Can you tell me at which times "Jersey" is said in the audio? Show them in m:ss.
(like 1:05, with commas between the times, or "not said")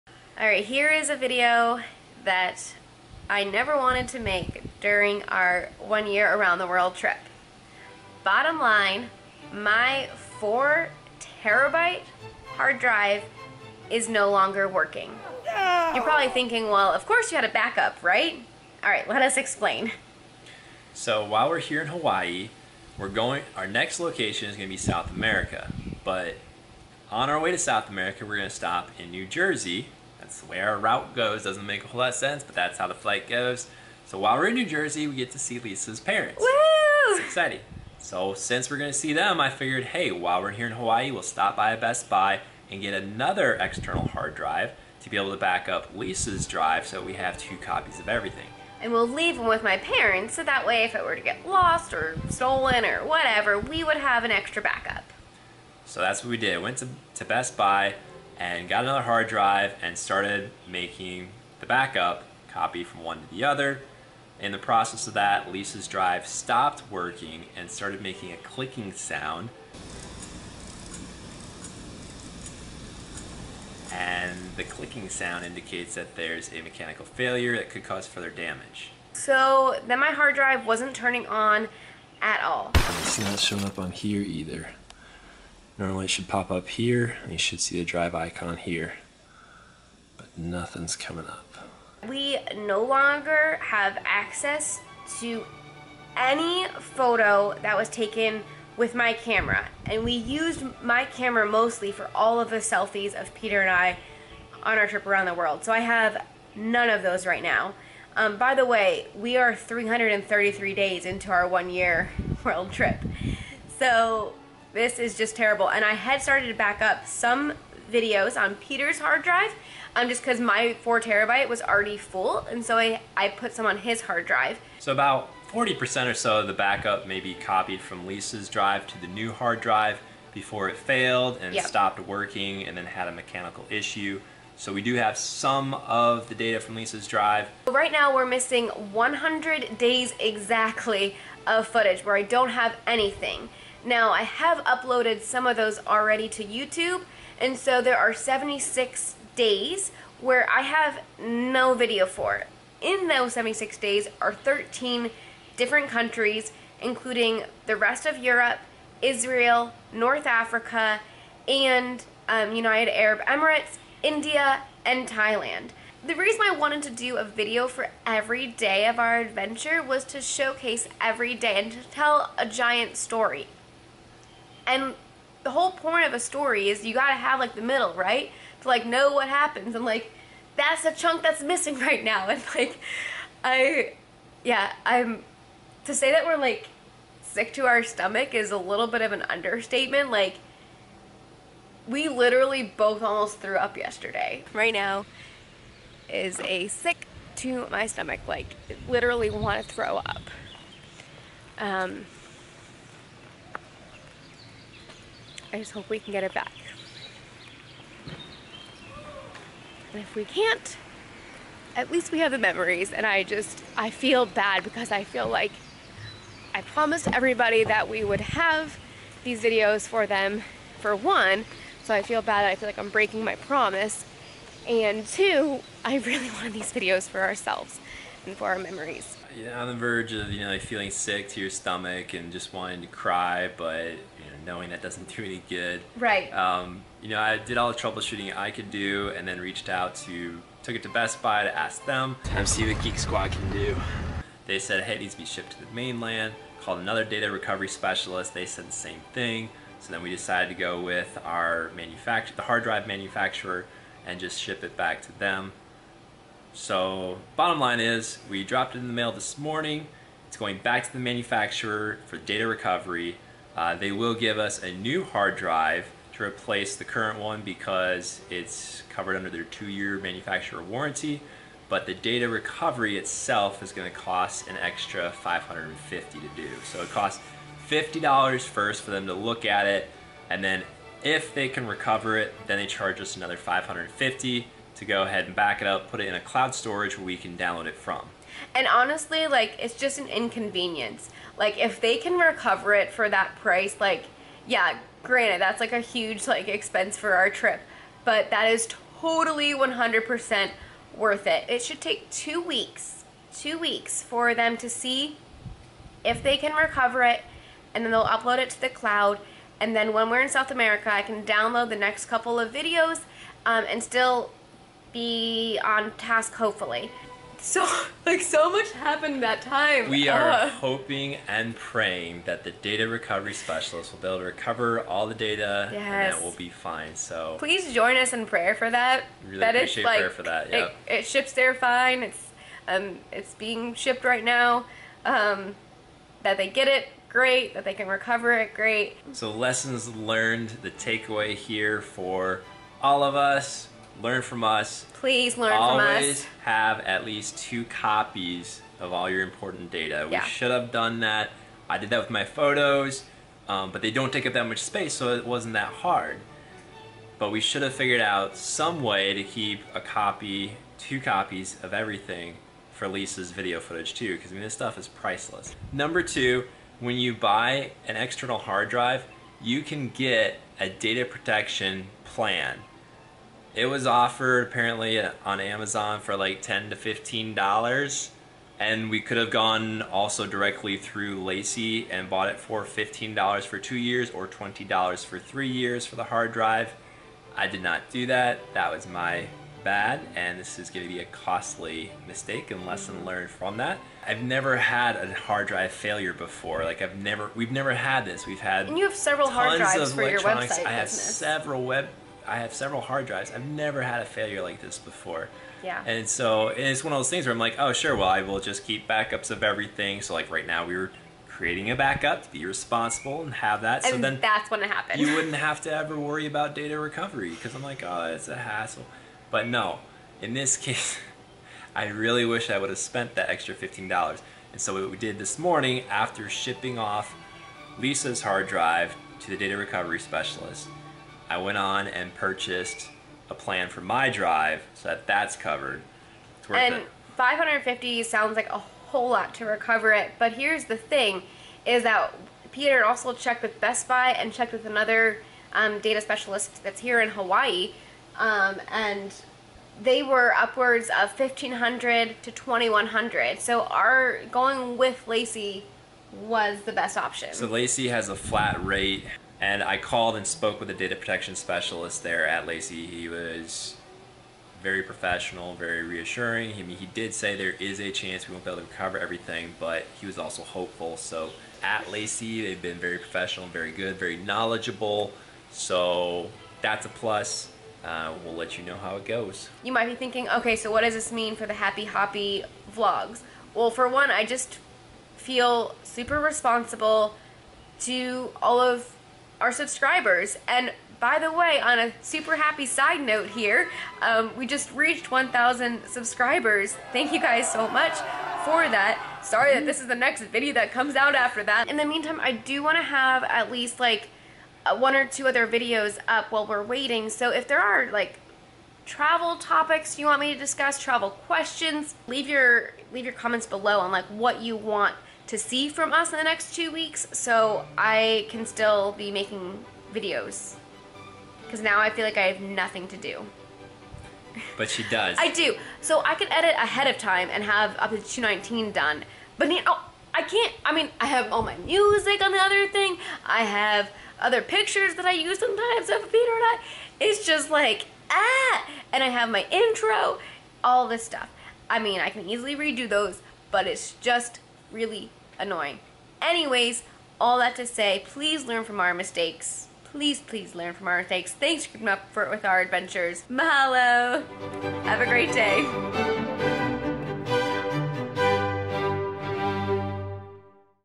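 0:29, 0:34.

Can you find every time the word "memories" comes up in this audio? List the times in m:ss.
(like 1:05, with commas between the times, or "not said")
3:32, 3:48.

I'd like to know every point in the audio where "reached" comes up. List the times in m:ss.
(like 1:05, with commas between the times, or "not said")
3:59, 8:14.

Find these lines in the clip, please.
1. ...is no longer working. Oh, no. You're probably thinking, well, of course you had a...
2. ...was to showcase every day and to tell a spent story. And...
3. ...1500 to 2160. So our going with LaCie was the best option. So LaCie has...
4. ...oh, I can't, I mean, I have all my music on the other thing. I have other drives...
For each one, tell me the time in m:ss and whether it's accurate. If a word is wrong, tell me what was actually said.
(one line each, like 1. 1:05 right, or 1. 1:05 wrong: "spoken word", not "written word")
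1. 0:13 right
2. 2:49 wrong: "giant", not "spent"
3. 7:31 wrong: "2100", not "2160"
4. 8:49 wrong: "pictures", not "drives".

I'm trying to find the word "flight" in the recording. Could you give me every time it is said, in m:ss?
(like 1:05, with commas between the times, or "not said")
0:32.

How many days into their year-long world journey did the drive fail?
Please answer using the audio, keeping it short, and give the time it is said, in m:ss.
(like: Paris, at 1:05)
333, at 1:49.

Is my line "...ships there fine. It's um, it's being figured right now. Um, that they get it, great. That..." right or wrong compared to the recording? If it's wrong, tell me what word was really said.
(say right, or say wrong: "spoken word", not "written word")
wrong: "shipped", not "figured".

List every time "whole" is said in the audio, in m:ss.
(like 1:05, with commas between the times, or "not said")
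0:31, 2:55, 7:18.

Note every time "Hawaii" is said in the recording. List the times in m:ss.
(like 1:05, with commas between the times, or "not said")
0:21, 0:40, 7:27.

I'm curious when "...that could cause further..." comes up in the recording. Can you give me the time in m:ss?
1:17.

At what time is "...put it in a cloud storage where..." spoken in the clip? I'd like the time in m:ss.
4:45.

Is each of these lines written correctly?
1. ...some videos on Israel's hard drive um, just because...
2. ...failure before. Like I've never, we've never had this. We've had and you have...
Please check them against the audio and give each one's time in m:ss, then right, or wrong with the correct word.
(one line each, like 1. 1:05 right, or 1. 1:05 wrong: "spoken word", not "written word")
1. 1:57 wrong: "Peter", not "Israel"
2. 6:35 right.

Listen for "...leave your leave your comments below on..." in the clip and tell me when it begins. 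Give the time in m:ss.
8:32.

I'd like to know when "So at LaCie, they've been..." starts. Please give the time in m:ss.
7:50.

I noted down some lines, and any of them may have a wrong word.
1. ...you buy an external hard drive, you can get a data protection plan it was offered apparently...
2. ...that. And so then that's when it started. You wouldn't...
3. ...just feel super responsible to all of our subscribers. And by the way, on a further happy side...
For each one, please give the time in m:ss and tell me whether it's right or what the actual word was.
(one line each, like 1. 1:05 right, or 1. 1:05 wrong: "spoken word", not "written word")
1. 6:06 right
2. 6:53 wrong: "happened", not "started"
3. 8:04 wrong: "super", not "further".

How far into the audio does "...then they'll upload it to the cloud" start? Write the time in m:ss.
5:07.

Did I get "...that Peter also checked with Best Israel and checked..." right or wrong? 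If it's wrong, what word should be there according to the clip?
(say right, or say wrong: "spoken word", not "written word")
wrong: "Buy", not "Israel".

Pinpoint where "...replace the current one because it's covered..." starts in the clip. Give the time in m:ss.
4:26.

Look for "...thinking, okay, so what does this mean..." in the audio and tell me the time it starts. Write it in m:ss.
7:59.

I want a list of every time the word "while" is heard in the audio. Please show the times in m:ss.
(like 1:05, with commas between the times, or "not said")
0:21, 0:34, 0:40, 8:26.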